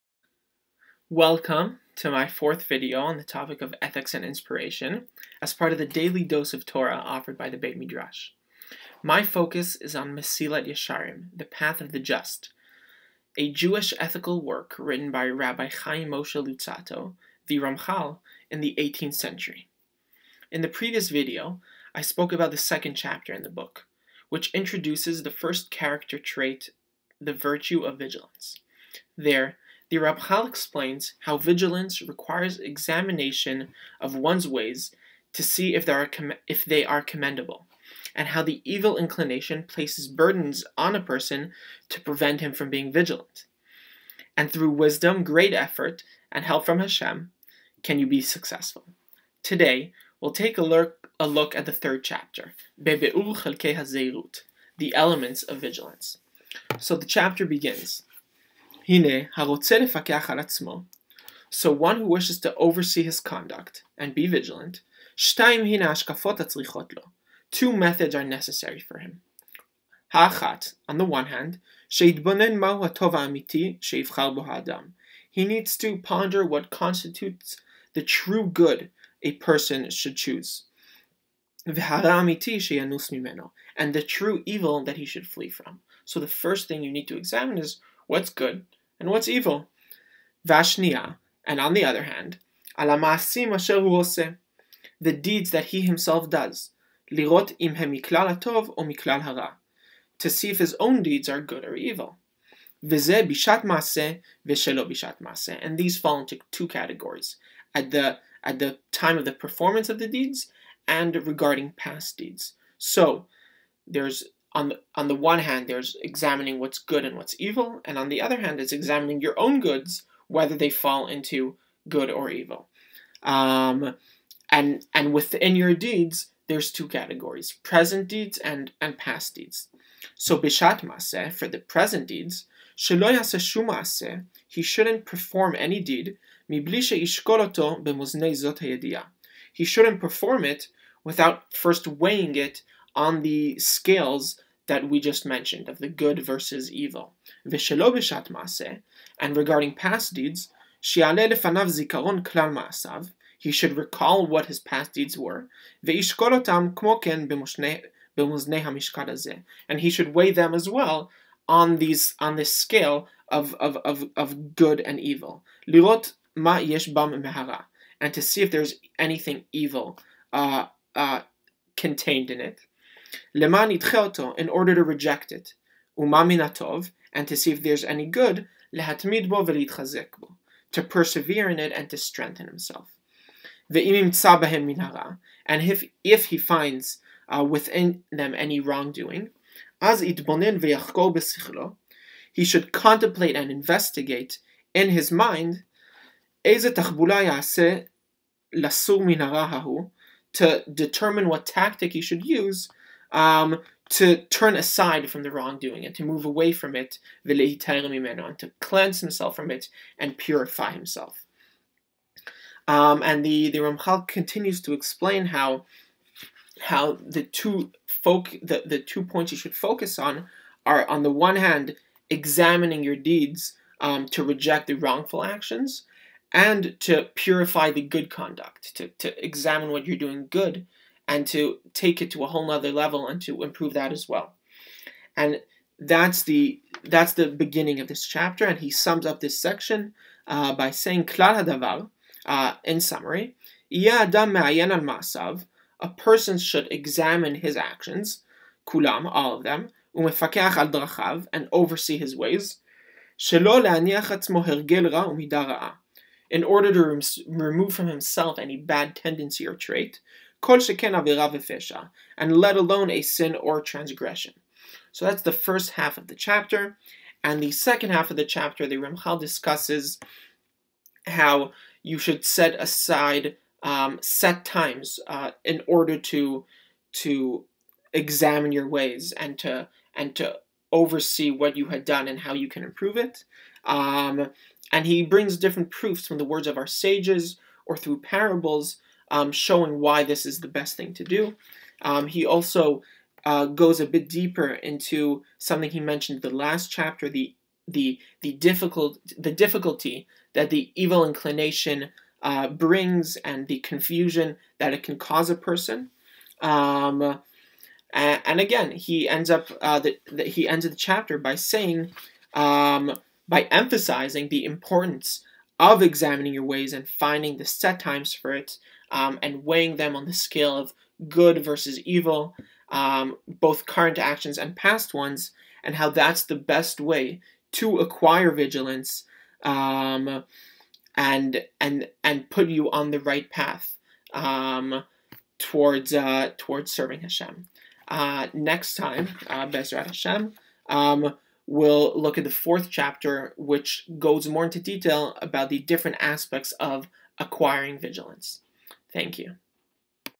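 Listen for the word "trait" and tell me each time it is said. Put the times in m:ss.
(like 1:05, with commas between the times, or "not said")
0:26, 4:19.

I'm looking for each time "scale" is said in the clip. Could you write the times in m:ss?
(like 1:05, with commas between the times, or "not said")
2:23, 2:42, 5:20.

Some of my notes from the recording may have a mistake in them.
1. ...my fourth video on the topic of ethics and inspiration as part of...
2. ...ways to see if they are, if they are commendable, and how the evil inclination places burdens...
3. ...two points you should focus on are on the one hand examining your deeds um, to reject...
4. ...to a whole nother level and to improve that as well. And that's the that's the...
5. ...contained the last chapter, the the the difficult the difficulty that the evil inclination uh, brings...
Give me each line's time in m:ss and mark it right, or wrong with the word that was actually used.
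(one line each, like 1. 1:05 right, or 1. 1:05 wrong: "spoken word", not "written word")
1. 0:02 right
2. 0:34 right
3. 3:38 right
4. 3:52 right
5. 4:55 wrong: "mentioned", not "contained".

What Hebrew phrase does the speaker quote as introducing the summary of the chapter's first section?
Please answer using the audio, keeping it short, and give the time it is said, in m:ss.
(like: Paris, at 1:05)
Klar hadavar, at 4:01.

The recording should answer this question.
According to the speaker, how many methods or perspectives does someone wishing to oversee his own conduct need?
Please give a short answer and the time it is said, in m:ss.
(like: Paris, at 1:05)
2, at 1:07.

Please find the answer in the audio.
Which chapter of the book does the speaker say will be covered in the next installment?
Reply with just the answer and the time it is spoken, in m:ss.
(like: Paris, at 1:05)
fourth chapter, at 5:42.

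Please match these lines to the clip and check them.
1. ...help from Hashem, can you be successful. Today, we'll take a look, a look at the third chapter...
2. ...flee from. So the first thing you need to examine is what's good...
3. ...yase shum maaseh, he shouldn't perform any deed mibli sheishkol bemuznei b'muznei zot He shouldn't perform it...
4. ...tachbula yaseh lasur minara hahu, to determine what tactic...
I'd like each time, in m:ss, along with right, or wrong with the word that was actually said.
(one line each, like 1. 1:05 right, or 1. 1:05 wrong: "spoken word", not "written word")
1. 0:46 right
2. 1:25 right
3. 2:13 right
4. 3:16 right.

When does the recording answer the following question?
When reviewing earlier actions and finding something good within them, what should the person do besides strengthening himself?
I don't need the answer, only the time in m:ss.
3:00.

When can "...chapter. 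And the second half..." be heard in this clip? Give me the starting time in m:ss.
4:26.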